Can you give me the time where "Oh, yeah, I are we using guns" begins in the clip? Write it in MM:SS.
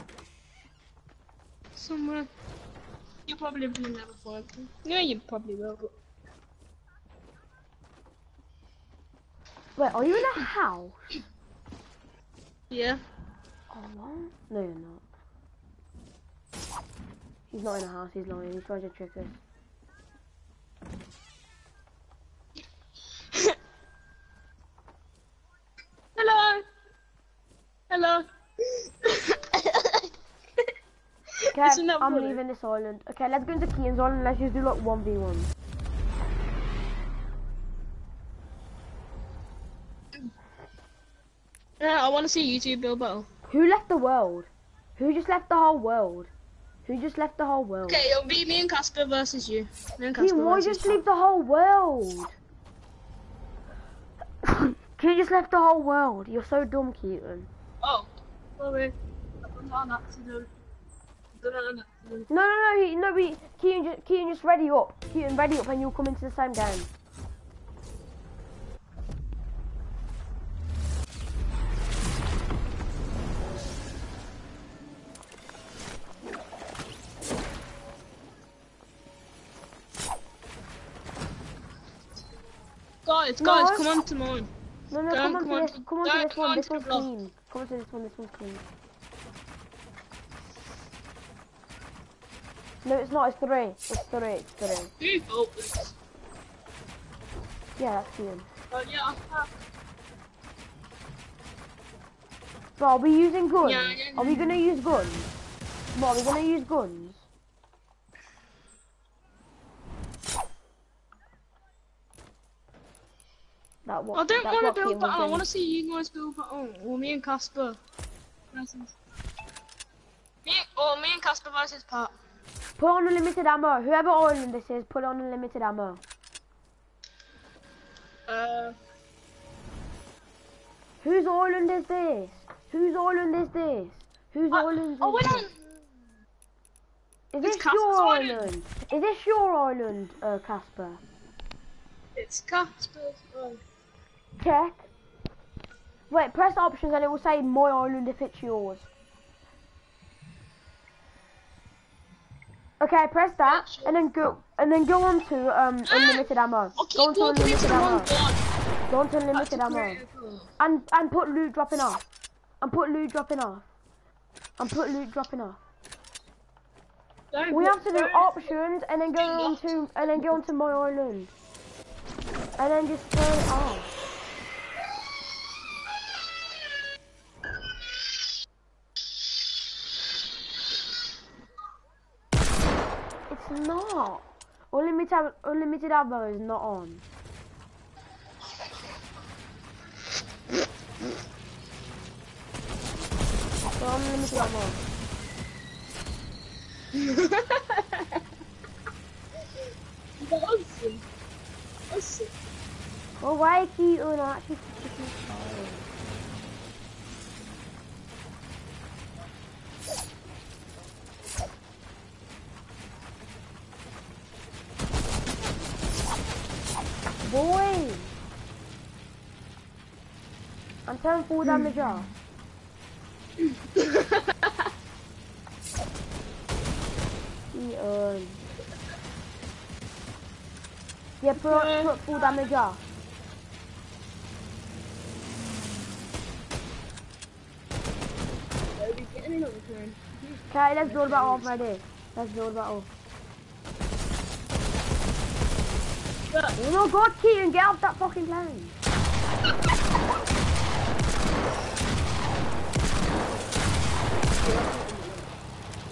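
01:38.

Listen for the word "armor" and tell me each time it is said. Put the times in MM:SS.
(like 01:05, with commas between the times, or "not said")
not said.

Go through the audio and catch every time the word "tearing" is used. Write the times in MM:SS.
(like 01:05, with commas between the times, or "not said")
03:40.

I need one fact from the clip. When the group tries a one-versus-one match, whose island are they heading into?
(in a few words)
Kian's island.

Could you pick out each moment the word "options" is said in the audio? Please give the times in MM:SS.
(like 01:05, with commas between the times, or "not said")
02:26, 02:48.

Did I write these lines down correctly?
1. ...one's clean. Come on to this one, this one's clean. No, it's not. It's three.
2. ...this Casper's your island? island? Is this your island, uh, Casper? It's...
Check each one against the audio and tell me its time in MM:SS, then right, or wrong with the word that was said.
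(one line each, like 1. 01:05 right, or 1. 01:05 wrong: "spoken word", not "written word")
1. 01:26 right
2. 02:17 right.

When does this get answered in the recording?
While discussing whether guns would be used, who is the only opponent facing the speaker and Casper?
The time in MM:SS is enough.
02:01.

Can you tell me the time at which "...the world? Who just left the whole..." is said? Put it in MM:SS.
00:43.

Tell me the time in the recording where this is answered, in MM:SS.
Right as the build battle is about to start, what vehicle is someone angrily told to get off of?
04:08.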